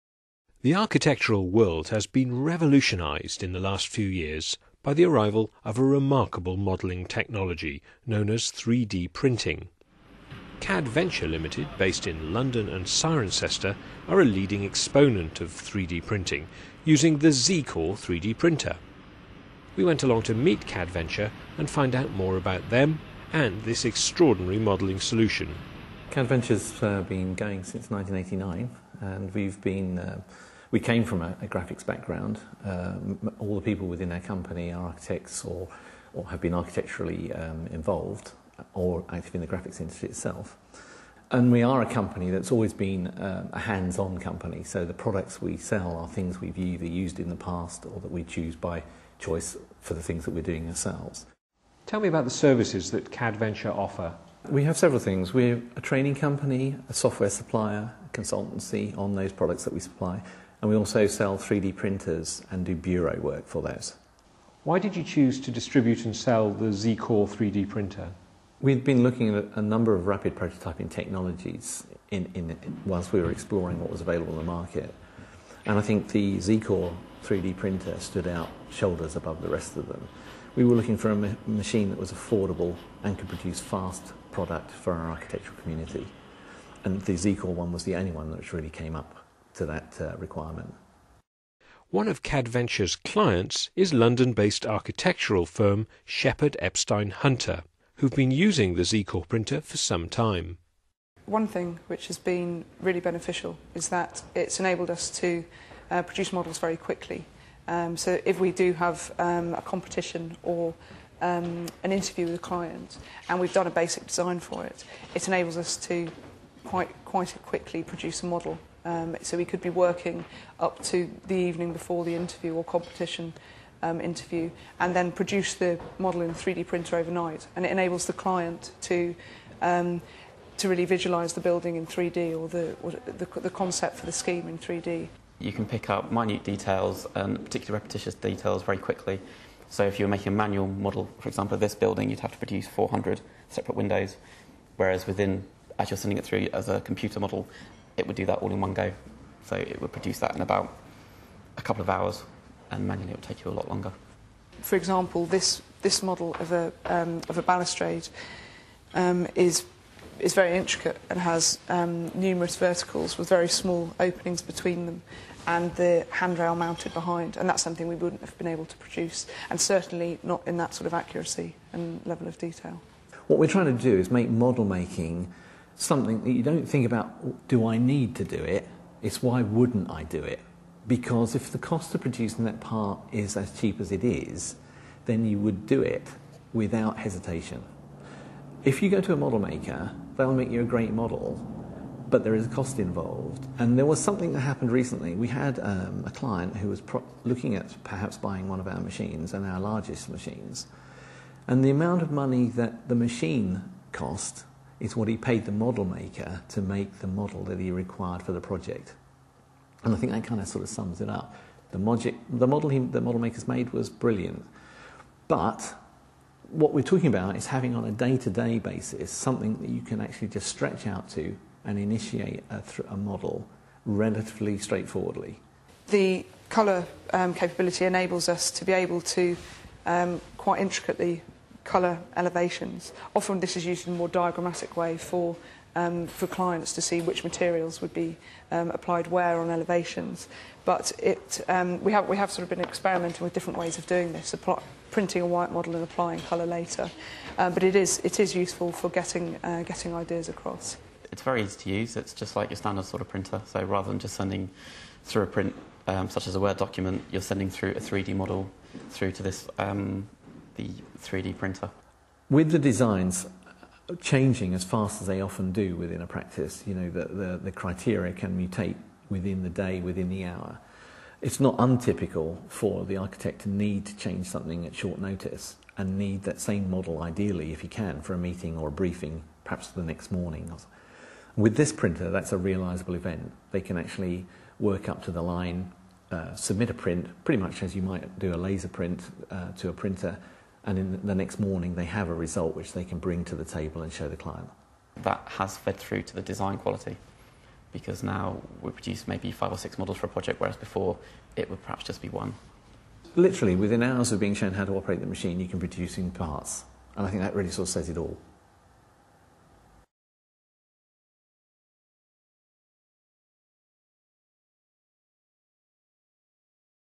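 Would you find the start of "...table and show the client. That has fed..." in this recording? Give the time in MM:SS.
04:53.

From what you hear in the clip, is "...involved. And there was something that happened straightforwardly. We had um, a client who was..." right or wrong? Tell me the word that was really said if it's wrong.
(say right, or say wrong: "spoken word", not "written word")
wrong: "recently", not "straightforwardly".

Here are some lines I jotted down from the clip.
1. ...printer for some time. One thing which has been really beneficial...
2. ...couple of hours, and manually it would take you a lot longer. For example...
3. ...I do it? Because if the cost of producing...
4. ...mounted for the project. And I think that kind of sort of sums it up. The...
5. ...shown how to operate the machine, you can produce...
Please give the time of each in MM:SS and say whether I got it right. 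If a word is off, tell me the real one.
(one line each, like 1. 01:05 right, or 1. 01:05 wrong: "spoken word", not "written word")
1. 01:39 right
2. 02:31 right
3. 02:59 right
4. 03:27 wrong: "required", not "mounted"
5. 05:04 right.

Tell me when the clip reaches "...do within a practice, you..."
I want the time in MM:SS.
04:25.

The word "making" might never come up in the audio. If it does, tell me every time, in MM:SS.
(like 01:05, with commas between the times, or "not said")
02:20, 02:54.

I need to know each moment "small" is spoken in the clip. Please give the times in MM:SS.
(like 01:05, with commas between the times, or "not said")
02:43.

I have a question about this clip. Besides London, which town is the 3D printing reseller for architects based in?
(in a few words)
Cirencester.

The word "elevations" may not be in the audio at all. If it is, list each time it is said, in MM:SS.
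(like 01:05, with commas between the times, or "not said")
03:52, 03:59.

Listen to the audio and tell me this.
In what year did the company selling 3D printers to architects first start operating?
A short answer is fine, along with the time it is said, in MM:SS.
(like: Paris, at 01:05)
1989, at 00:27.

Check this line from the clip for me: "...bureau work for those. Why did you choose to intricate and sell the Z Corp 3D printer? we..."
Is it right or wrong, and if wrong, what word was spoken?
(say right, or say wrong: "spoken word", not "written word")
wrong: "distribute", not "intricate".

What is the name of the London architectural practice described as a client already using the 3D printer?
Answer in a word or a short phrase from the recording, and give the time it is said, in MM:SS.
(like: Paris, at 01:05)
Shepheard Epstein Hunter, at 01:36.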